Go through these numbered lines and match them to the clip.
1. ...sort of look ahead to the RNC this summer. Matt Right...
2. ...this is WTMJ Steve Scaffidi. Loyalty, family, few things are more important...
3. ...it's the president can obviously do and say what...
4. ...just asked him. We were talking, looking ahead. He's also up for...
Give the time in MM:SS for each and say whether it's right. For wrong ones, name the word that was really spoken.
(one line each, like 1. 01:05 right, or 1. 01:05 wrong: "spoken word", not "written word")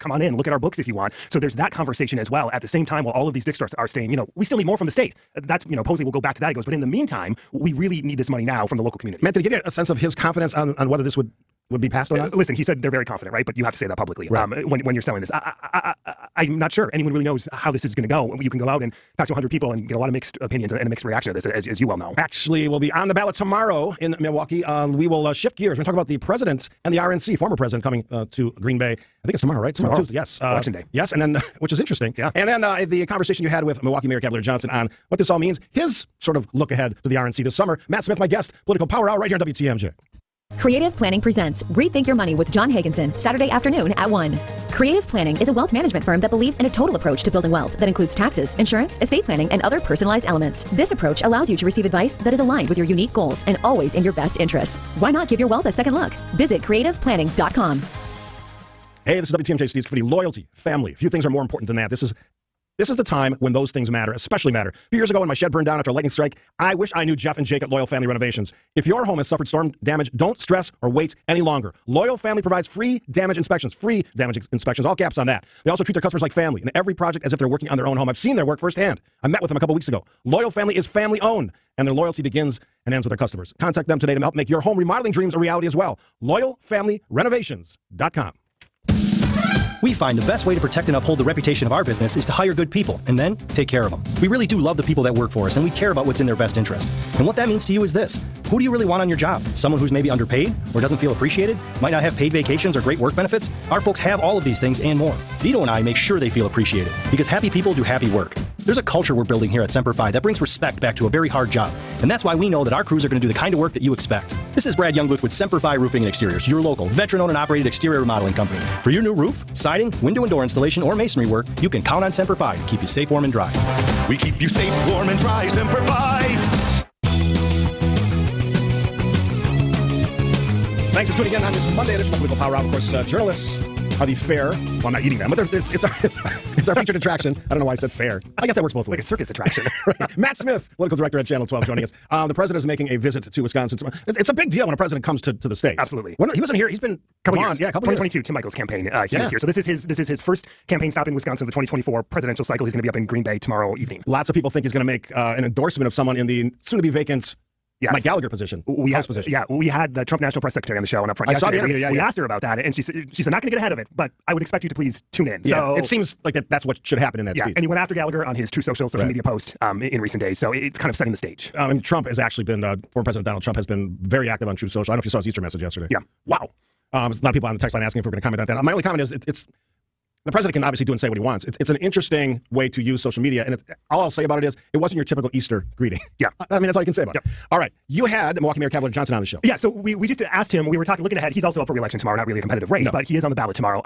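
1. 00:36 wrong: "Smith", not "Right"
2. 00:59 right
3. 02:59 right
4. 03:10 right.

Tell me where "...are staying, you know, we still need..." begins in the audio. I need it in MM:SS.
00:03.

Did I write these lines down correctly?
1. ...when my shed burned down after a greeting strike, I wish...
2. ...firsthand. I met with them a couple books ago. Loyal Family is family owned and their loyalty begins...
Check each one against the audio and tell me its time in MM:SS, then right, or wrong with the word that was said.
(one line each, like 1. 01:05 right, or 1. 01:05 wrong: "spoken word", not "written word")
1. 01:05 wrong: "lightning", not "greeting"
2. 01:18 wrong: "weeks", not "books".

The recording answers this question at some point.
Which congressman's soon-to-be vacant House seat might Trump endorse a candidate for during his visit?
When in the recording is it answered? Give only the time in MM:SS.
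02:37.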